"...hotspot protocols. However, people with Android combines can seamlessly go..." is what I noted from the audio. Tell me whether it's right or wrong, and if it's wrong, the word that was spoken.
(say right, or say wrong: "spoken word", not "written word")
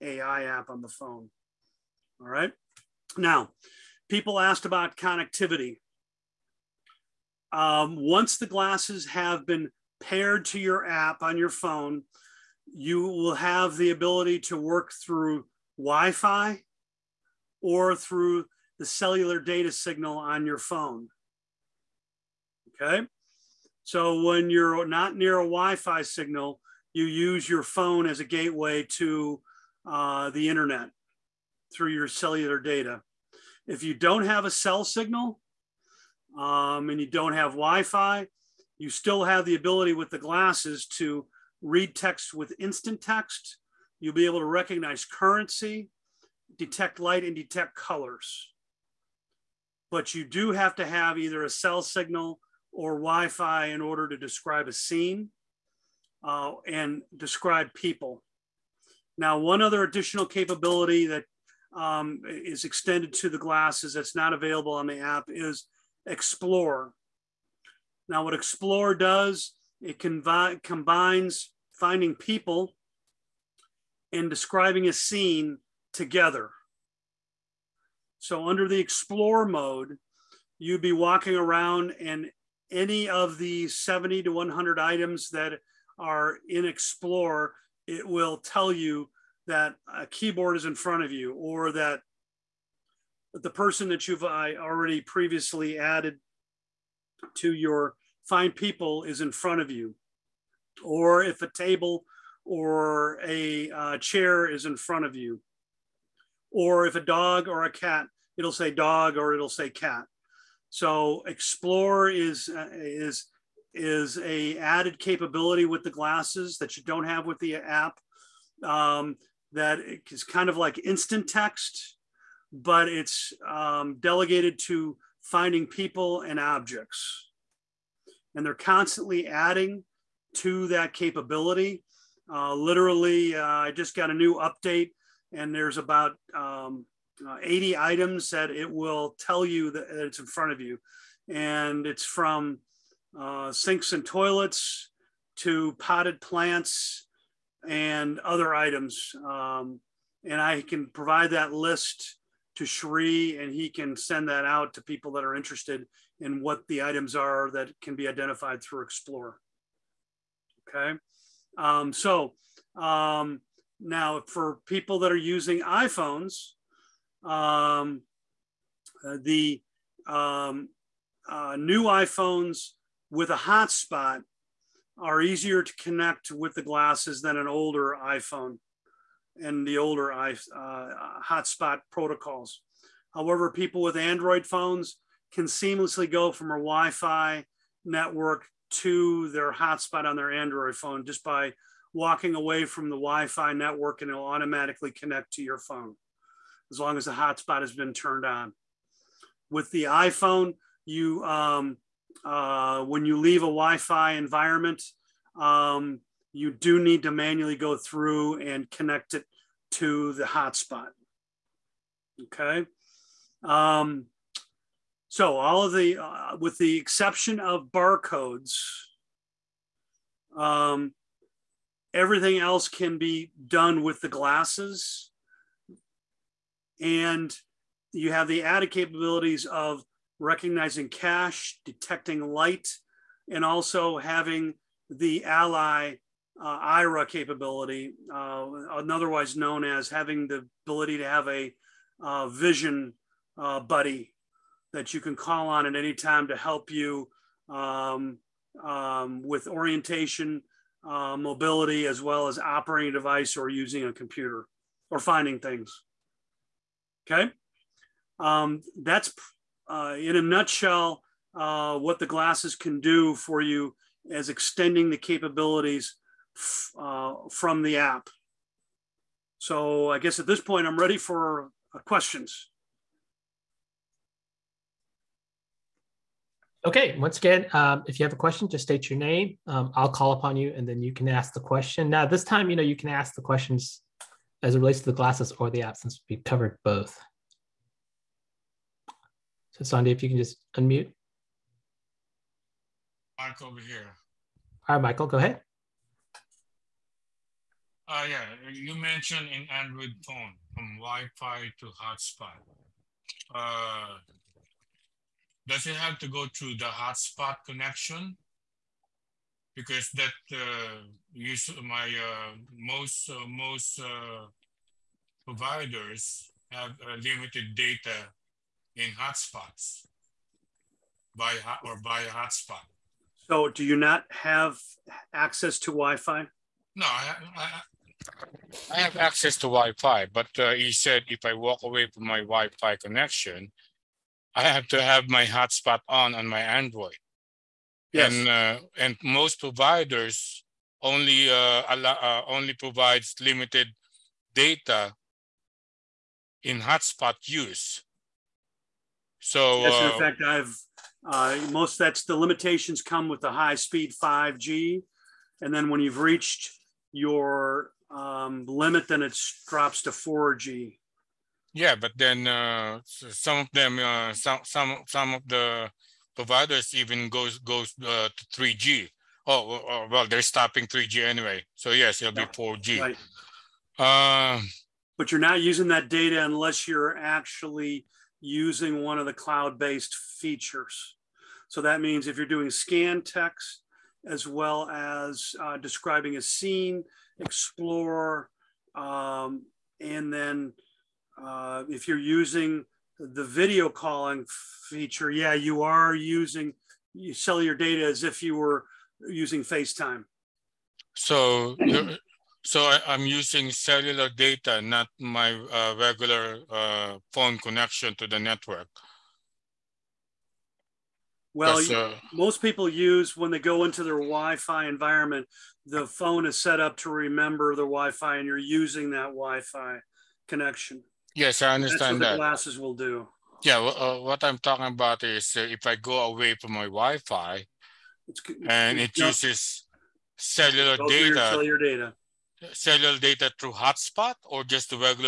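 wrong: "phones", not "combines".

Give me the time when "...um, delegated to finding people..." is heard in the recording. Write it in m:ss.
2:03.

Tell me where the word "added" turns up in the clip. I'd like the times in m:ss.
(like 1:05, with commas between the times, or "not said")
1:35, 1:54, 3:48.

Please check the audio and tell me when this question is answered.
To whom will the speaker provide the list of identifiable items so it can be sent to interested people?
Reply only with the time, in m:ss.
2:32.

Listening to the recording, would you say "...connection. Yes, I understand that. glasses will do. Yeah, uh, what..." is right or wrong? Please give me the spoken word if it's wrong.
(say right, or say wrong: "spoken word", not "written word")
right.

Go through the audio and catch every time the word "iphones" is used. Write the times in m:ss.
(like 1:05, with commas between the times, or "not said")
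2:45, 2:51, 2:58, 3:19.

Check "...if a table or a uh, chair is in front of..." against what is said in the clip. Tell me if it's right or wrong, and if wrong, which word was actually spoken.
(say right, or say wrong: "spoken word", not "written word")
right.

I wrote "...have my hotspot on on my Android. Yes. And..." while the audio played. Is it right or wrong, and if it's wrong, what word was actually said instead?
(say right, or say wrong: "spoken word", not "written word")
right.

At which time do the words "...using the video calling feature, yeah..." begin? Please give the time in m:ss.
6:31.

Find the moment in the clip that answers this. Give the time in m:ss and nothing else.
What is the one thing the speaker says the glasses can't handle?
3:37.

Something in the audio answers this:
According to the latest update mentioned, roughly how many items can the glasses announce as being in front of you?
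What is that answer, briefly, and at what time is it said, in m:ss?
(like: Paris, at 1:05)
80, at 2:17.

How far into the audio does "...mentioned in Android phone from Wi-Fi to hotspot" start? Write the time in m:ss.
4:58.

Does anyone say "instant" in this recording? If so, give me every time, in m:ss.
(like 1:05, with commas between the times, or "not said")
0:42, 2:00.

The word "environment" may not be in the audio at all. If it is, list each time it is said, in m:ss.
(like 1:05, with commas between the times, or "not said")
3:24, 6:54.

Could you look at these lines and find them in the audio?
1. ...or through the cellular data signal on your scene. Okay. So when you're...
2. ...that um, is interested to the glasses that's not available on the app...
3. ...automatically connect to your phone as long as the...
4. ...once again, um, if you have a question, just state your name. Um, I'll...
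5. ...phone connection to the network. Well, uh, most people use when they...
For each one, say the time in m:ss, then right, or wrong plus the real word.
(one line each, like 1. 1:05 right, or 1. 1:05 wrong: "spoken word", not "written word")
1. 0:17 wrong: "phone", not "scene"
2. 1:01 wrong: "extended", not "interested"
3. 3:14 right
4. 4:36 right
5. 6:47 right.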